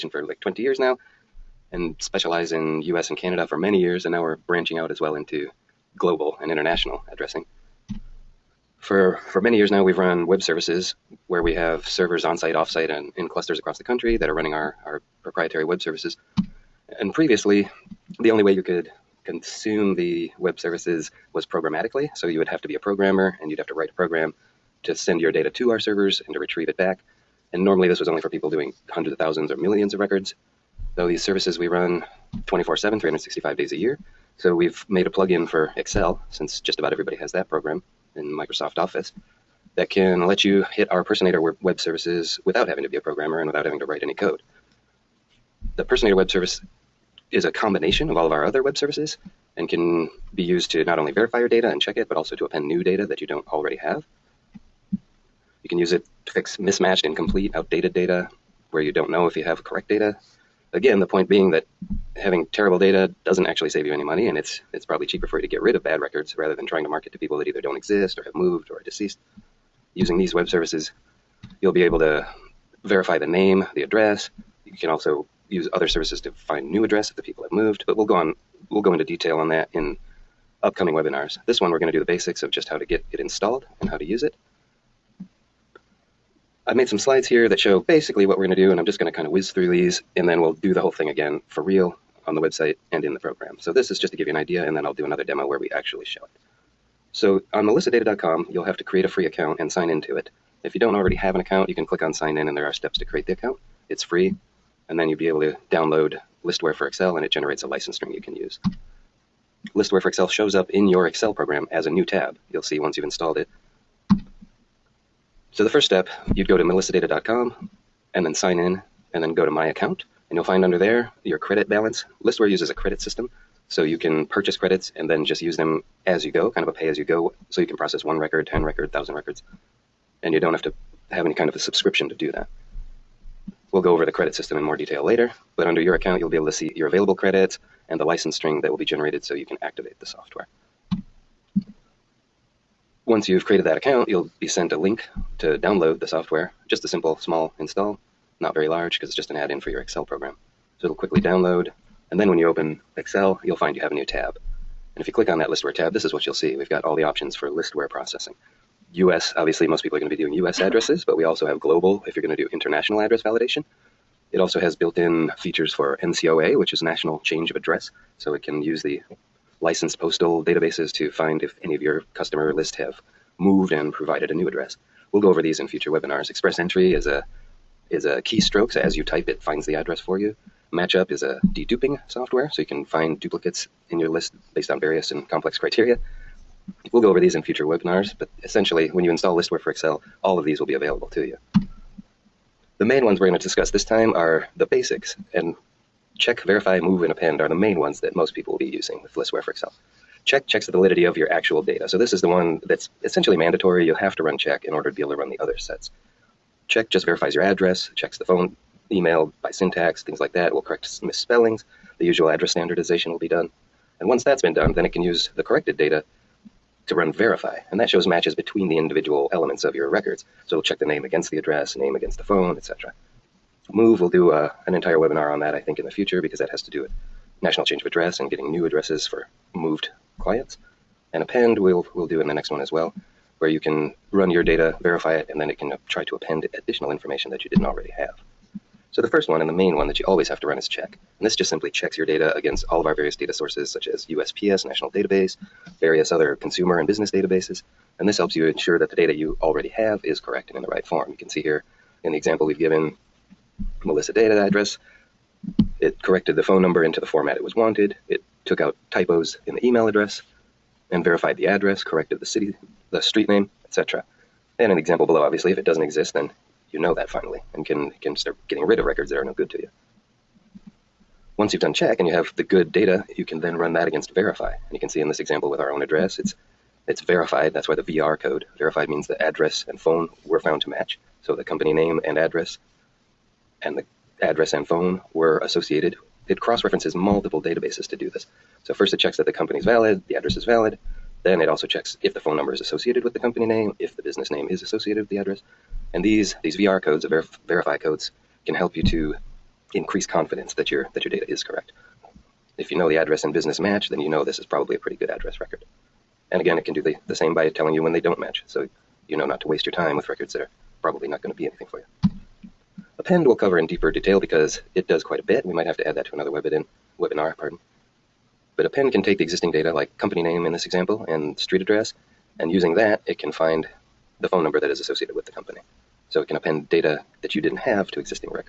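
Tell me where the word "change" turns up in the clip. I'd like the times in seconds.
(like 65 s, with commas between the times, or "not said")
167 s, 227 s.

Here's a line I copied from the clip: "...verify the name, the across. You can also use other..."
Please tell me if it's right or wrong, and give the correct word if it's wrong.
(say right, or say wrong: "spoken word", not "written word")
wrong: "address", not "across".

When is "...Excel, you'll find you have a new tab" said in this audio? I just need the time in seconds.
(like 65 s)
152 s.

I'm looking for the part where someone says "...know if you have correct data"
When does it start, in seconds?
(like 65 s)
59 s.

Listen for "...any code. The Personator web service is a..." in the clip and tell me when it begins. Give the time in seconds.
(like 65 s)
44 s.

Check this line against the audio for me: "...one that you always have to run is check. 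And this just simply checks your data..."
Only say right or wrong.
right.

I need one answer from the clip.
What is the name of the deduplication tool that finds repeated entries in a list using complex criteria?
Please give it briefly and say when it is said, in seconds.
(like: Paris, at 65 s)
Matchup, at 180 s.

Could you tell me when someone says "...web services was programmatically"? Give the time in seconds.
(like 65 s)
20 s.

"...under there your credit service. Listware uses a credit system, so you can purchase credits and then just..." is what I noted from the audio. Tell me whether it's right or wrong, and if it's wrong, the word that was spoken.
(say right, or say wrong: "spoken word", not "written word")
wrong: "balance", not "service".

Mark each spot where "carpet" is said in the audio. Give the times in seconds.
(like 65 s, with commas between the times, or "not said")
not said.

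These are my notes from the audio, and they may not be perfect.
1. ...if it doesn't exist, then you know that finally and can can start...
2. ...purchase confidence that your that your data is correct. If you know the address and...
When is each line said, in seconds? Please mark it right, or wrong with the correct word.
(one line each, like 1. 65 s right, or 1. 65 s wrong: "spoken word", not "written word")
1. 265 s right
2. 299 s wrong: "increase", not "purchase".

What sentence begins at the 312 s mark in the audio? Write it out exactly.
Append will cover in deeper detail because it does quite a bit.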